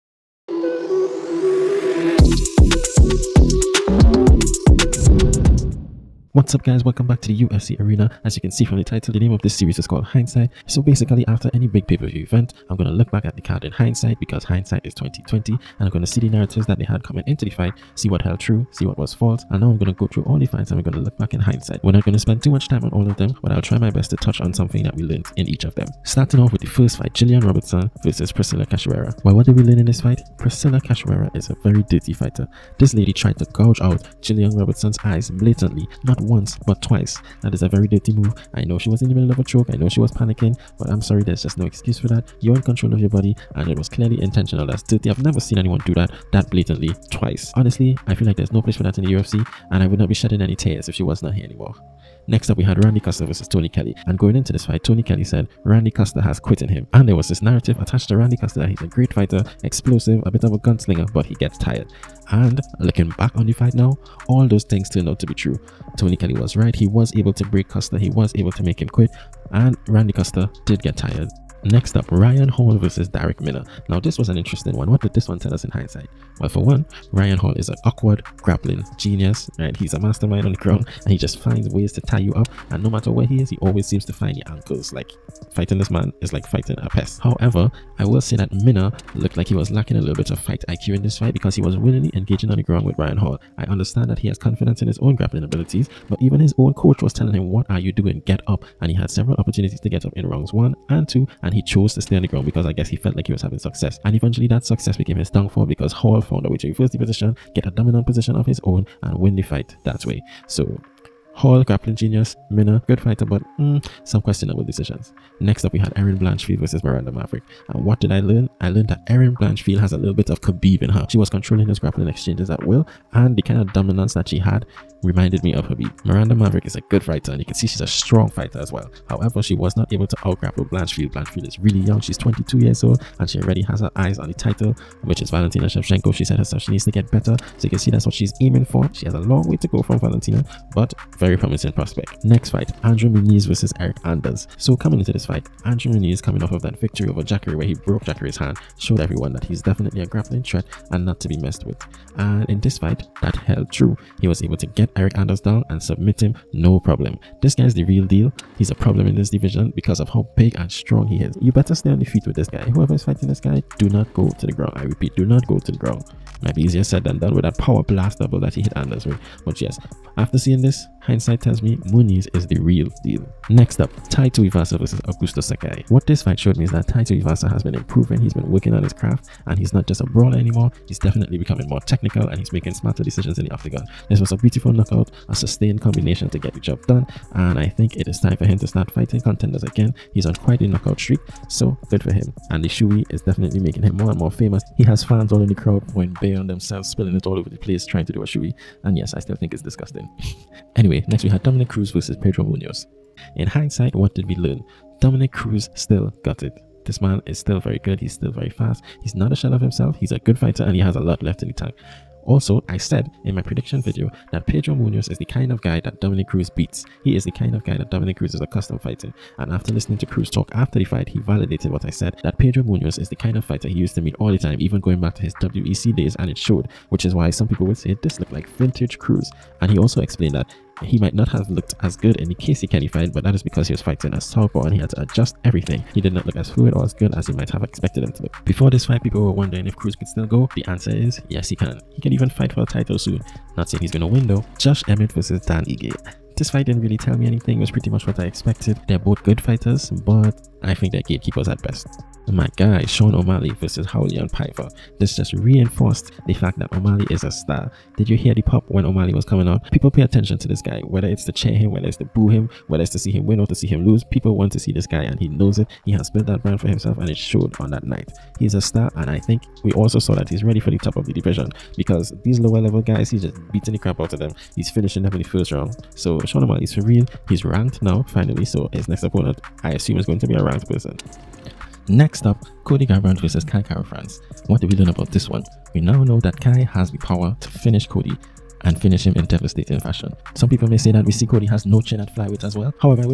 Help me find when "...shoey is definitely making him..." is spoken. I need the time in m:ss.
3:12.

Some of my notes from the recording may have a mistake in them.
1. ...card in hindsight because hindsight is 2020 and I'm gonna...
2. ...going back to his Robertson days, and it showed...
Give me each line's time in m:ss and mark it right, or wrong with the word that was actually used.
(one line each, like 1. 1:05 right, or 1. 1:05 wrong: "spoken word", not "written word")
1. 0:13 right
2. 3:44 wrong: "WEC", not "Robertson".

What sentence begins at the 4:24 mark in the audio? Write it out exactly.
People want to see this guy, and he knows it.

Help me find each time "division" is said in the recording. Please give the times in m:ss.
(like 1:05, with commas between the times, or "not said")
2:39, 4:31.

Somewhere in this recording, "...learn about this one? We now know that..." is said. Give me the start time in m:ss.
4:44.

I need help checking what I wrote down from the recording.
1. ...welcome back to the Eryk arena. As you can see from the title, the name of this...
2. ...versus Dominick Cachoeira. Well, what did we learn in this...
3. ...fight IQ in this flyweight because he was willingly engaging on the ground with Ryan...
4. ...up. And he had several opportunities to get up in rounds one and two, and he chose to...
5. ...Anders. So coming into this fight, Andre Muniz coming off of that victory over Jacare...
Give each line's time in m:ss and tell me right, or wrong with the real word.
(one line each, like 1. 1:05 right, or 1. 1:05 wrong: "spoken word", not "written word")
1. 0:06 wrong: "UFC", not "Eryk"
2. 0:28 wrong: "Priscilla", not "Dominick"
3. 1:30 wrong: "fight", not "flyweight"
4. 1:38 right
5. 2:24 right.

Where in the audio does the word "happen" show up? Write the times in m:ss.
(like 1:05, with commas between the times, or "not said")
not said.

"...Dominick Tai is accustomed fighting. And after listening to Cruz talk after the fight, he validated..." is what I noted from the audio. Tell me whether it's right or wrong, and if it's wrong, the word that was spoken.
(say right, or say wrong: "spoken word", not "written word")
wrong: "Cruz", not "Tai".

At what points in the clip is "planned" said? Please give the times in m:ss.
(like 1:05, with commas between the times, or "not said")
not said.